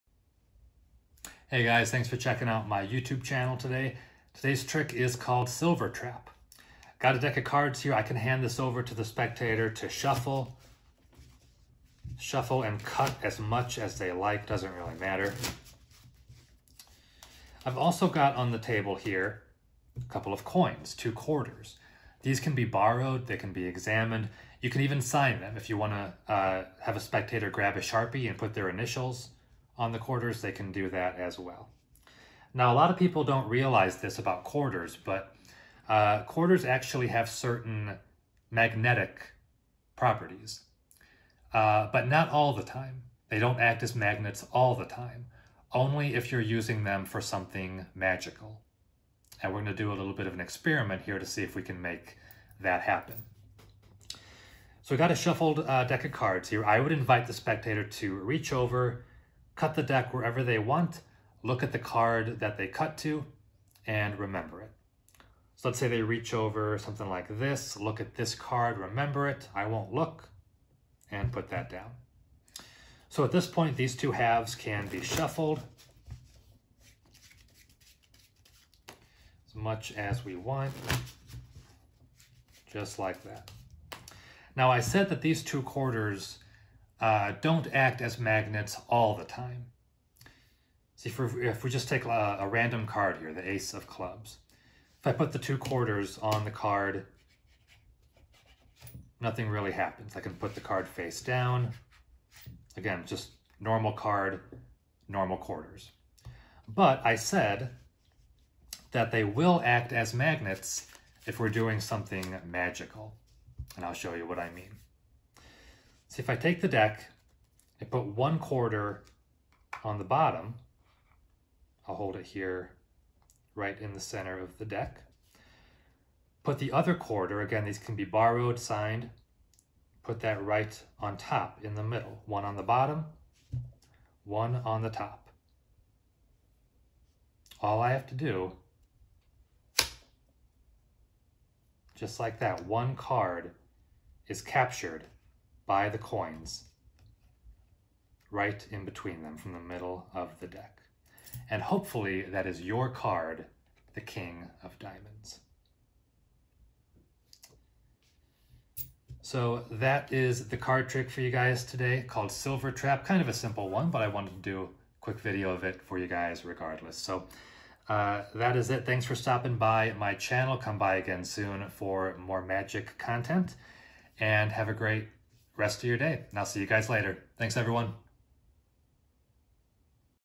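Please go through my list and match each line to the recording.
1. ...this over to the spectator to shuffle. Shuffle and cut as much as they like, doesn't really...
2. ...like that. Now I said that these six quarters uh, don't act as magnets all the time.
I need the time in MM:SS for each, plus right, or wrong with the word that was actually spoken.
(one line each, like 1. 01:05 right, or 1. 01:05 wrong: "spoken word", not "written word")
1. 00:08 right
2. 01:22 wrong: "two", not "six".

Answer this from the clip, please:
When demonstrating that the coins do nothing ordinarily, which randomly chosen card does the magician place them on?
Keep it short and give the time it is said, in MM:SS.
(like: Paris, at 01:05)
Ace of clubs, at 01:33.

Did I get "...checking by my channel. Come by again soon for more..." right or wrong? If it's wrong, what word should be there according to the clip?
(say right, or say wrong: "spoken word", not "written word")
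wrong: "stopping", not "checking".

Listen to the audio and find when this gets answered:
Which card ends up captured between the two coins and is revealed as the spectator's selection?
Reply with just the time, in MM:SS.
02:34.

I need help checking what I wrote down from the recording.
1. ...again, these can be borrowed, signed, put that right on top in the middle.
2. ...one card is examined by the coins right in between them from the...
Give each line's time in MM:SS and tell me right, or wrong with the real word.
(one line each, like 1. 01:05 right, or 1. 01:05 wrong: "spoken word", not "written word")
1. 02:07 right
2. 02:22 wrong: "captured", not "examined".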